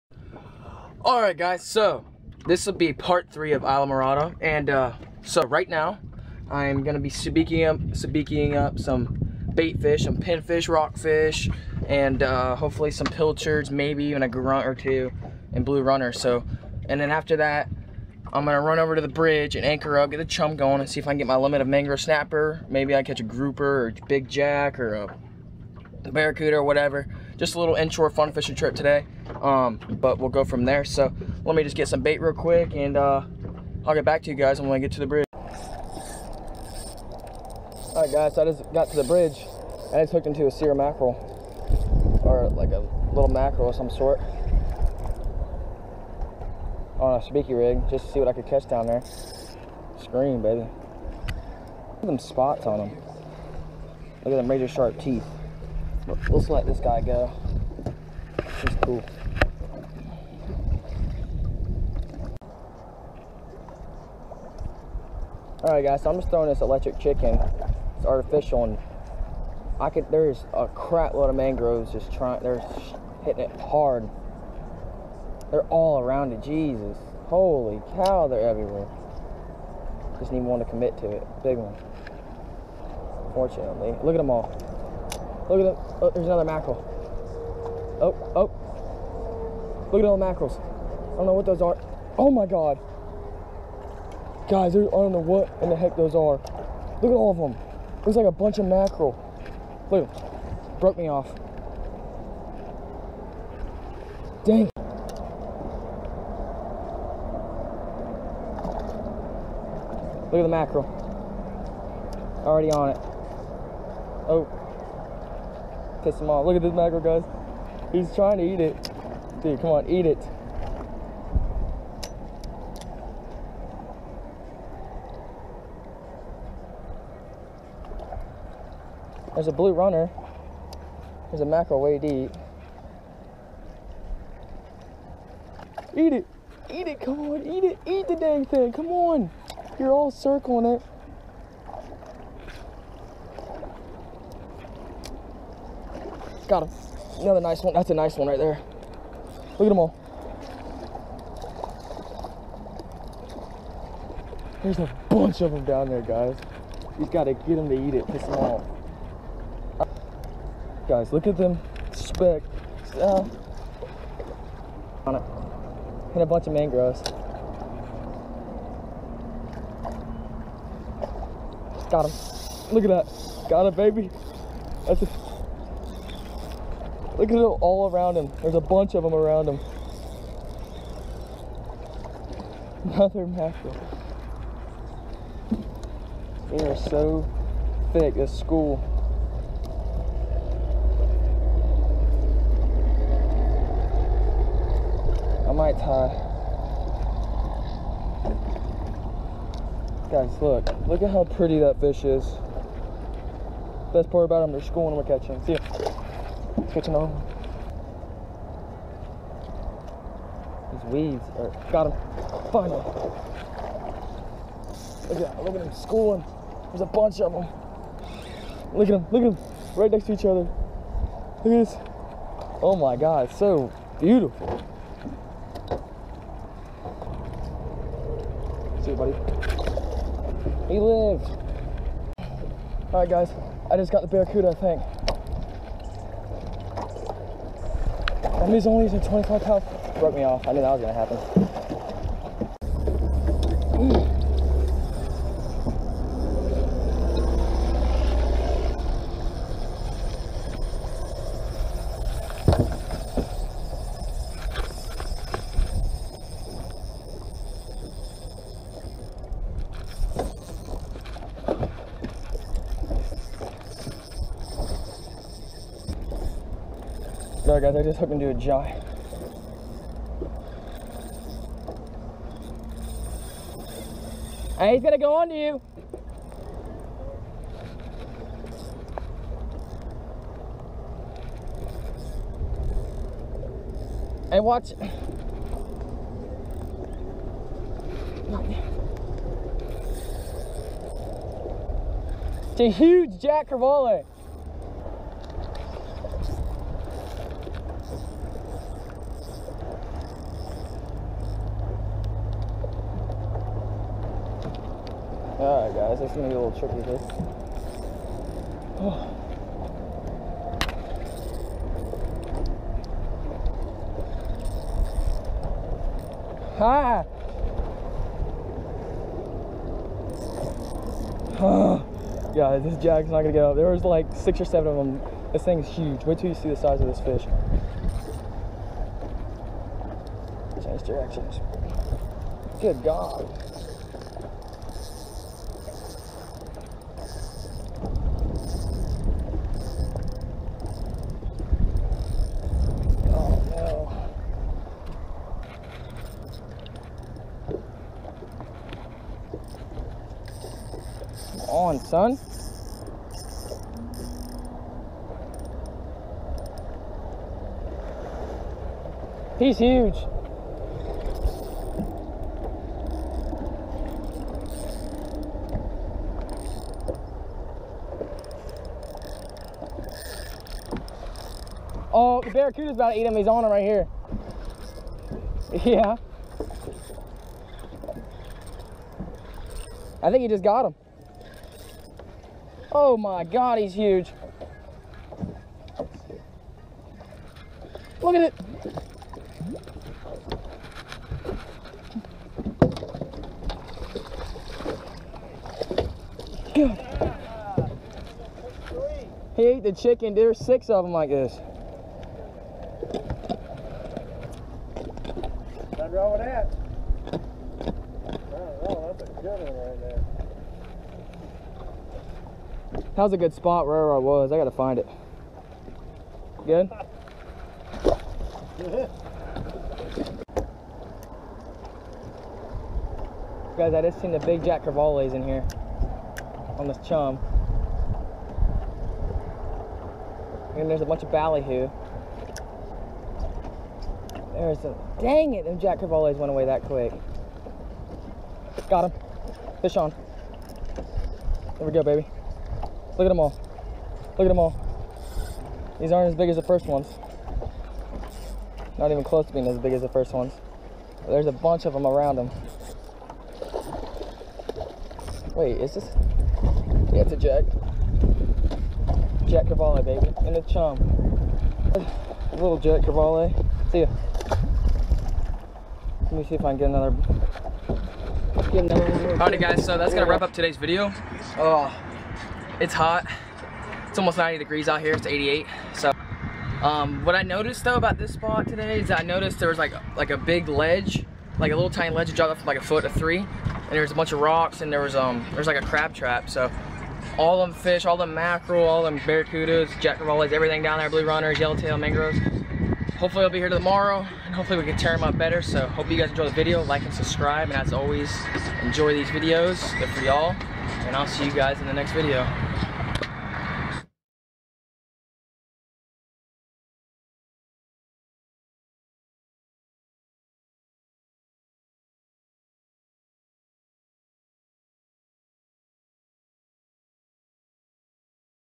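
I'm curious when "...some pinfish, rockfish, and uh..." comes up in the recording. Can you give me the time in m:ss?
0:10.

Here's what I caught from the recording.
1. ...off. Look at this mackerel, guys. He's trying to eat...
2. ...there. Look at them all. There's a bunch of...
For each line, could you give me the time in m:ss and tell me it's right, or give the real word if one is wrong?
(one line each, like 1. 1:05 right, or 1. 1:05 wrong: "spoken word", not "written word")
1. 1:56 right
2. 2:28 right.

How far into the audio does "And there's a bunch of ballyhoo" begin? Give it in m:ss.
7:10.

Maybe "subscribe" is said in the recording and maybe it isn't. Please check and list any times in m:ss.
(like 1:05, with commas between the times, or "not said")
8:16.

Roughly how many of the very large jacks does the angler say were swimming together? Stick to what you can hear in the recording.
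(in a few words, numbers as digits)
Six or seven.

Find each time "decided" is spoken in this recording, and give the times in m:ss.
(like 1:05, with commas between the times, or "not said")
not said.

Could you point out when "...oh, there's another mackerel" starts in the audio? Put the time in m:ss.
1:26.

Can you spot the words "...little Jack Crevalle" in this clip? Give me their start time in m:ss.
7:42.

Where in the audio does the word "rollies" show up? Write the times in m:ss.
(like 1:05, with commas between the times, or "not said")
8:09.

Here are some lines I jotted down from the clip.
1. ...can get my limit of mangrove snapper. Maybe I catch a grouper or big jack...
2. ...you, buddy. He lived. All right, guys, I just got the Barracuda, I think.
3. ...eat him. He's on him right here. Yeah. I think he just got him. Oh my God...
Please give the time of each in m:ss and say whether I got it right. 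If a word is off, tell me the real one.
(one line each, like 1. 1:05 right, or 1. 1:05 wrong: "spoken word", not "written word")
1. 0:21 right
2. 3:48 right
3. 6:12 right.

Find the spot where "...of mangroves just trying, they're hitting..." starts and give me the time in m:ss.
1:11.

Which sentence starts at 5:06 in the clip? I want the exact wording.
This it's gonna be a little tricky this.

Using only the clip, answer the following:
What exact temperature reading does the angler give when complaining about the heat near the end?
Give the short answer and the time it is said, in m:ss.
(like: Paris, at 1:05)
88, at 7:55.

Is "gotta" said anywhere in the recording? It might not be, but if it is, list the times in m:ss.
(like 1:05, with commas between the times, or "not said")
2:37, 6:54.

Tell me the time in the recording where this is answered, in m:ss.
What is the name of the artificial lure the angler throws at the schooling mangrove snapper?
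1:06.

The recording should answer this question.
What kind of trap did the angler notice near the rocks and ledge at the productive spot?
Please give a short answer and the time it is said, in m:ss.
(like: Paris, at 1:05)
Crab trap, at 8:05.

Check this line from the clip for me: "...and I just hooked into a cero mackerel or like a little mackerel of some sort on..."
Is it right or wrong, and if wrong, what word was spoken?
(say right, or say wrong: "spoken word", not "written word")
right.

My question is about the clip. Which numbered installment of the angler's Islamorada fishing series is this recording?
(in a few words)
Part three.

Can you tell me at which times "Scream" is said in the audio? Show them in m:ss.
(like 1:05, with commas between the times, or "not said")
0:50.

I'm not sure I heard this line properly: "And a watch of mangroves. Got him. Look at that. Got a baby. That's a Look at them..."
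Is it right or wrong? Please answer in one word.
wrong.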